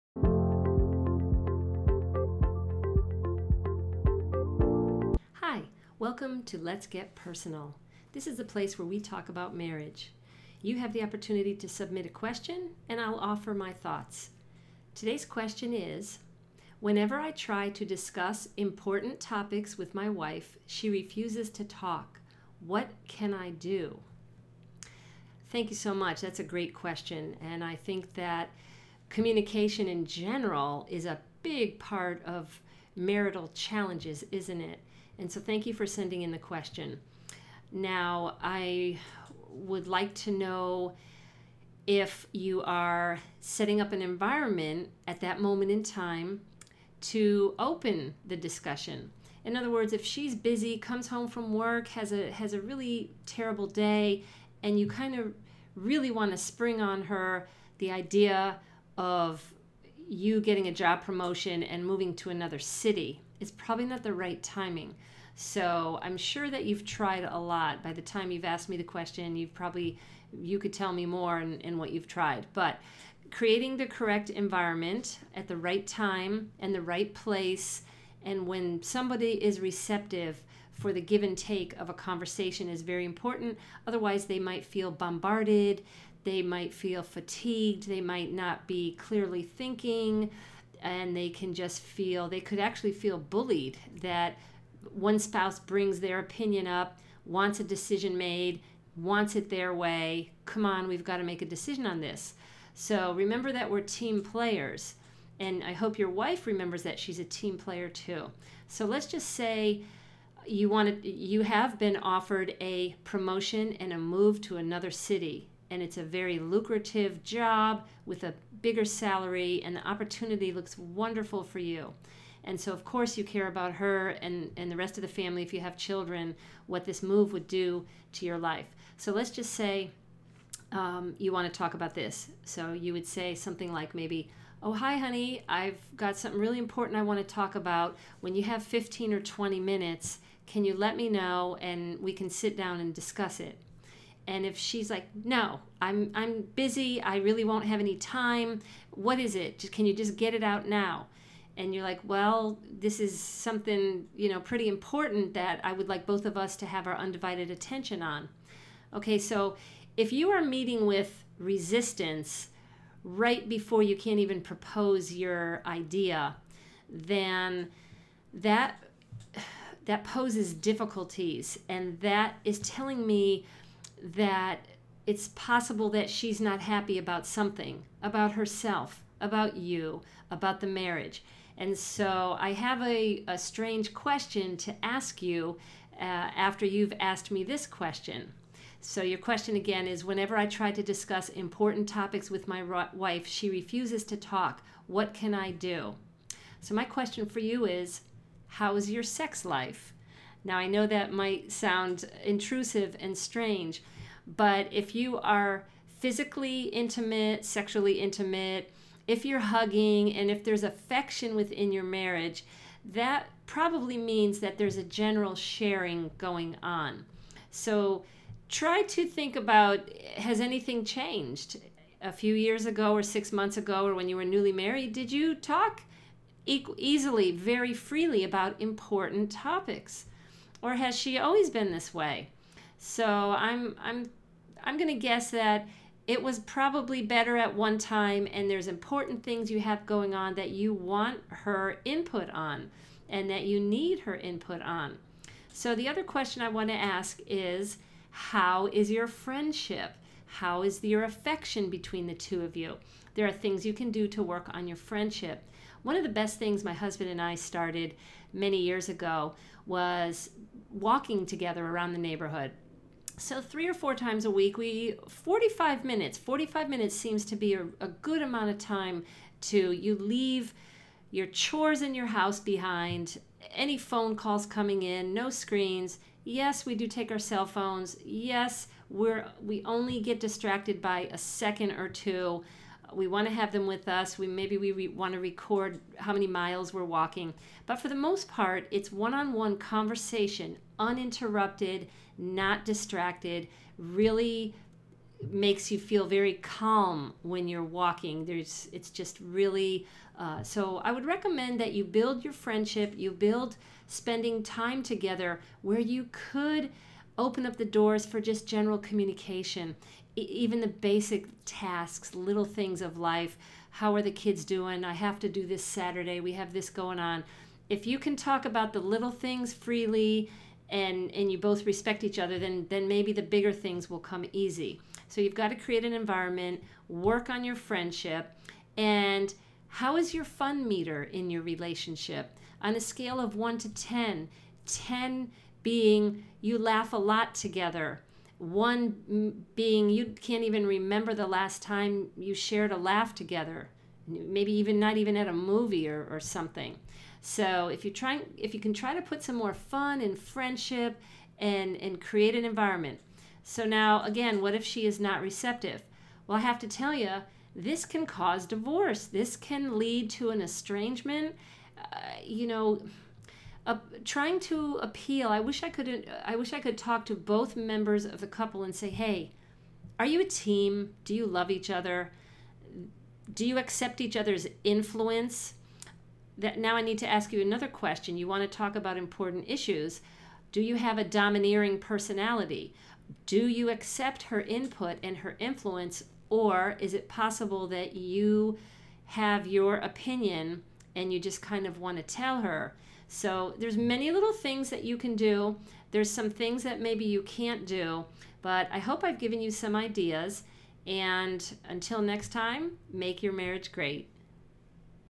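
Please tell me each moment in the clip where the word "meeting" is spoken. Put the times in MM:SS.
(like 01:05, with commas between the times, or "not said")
02:40.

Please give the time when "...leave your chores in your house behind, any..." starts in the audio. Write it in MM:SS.
04:29.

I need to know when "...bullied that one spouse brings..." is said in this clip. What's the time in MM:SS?
01:33.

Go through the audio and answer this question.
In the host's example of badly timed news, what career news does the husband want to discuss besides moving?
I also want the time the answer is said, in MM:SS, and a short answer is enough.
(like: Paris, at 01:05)
a job promotion, at 01:00.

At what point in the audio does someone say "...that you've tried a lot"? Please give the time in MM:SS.
01:06.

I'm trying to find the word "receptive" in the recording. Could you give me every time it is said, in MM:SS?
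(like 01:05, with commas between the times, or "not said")
01:19, 05:55.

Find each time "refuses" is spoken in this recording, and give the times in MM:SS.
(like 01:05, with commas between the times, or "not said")
00:20, 03:13.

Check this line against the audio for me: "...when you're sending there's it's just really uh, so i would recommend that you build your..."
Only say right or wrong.
wrong.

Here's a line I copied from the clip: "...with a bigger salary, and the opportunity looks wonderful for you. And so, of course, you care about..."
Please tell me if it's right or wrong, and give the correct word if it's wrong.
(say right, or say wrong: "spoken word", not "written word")
right.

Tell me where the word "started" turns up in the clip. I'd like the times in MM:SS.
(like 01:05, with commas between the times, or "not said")
04:17.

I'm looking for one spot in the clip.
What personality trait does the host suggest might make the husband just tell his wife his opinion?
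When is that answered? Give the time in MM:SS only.
06:21.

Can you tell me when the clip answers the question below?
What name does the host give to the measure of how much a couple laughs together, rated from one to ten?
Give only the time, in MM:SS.
05:30.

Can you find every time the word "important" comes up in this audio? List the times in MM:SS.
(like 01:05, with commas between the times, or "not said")
00:18, 01:23, 02:16, 02:34, 03:11, 03:48, 03:58, 06:18.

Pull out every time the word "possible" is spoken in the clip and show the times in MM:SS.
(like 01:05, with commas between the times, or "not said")
02:55, 06:27.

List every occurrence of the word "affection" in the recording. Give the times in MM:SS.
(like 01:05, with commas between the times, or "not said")
03:30, 04:11.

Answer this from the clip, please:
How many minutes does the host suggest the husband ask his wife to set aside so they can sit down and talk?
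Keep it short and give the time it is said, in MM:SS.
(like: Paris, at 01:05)
15 or 20, at 02:18.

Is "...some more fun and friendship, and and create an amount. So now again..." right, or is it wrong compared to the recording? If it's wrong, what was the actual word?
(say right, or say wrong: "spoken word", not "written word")
wrong: "environment", not "amount".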